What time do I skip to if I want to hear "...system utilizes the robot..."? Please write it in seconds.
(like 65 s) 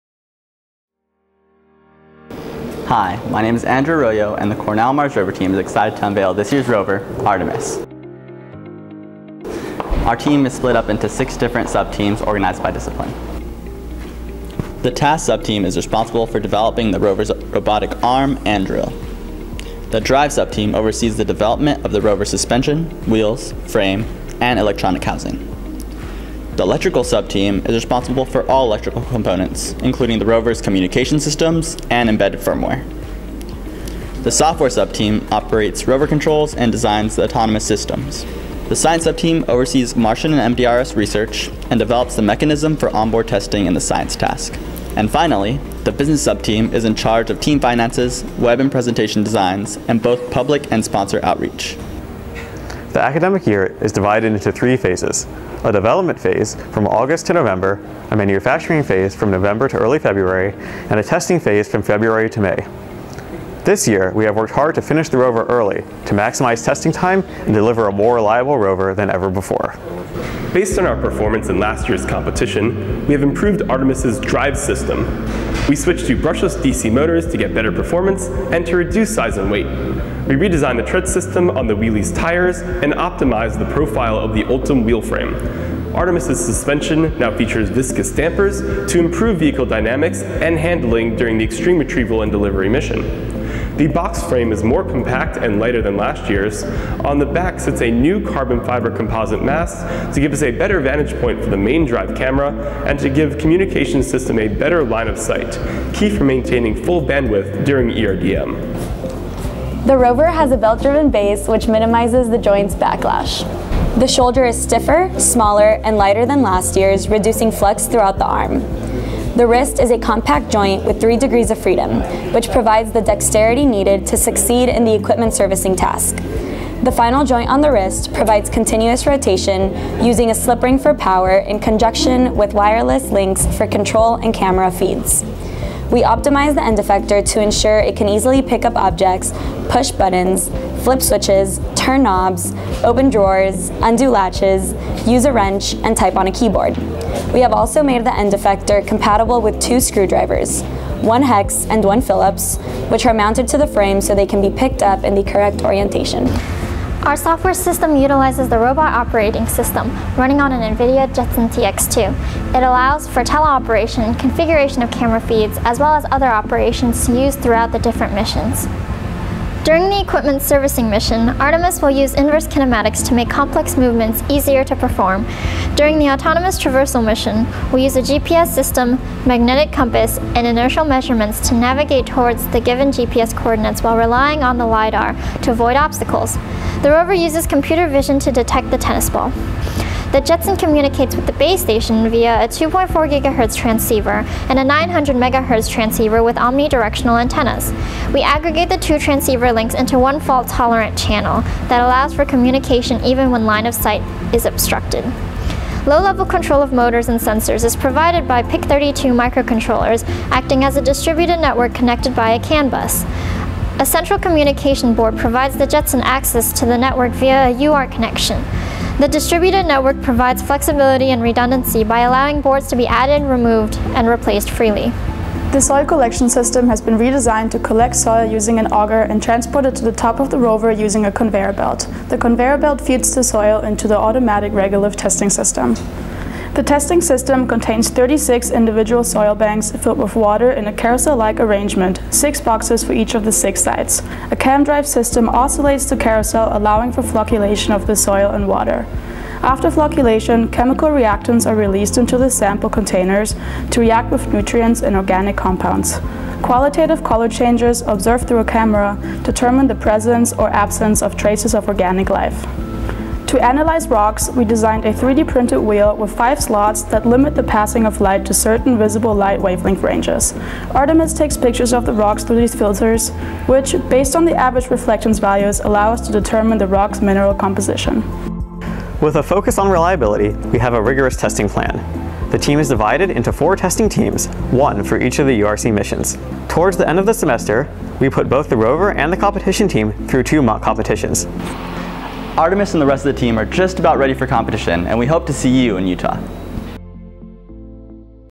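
157 s.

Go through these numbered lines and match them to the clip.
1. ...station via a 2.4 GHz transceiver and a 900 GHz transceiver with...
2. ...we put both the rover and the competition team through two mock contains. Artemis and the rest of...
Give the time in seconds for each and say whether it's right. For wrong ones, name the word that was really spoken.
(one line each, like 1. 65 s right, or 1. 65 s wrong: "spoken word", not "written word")
1. 191 s wrong: "MHz", not "GHz"
2. 288 s wrong: "competitions", not "contains".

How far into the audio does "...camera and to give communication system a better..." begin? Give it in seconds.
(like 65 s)
102 s.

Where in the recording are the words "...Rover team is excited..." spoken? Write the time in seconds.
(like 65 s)
5 s.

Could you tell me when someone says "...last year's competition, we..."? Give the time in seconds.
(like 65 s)
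71 s.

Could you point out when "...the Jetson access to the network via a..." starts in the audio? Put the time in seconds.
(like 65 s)
215 s.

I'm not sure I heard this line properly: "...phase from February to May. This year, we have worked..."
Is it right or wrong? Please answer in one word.
right.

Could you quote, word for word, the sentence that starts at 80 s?
We redesigned the tread system on the wheelie's tires and optimized the profile of the Ultem wheel frame.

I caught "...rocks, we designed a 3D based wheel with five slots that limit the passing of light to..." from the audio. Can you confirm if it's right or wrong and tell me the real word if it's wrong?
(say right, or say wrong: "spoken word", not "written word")
wrong: "printed", not "based".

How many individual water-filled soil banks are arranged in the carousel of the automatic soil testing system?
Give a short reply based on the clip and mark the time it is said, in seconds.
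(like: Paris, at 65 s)
36, at 237 s.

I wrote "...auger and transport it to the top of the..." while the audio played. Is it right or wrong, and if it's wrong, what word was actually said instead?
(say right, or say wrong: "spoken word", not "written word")
right.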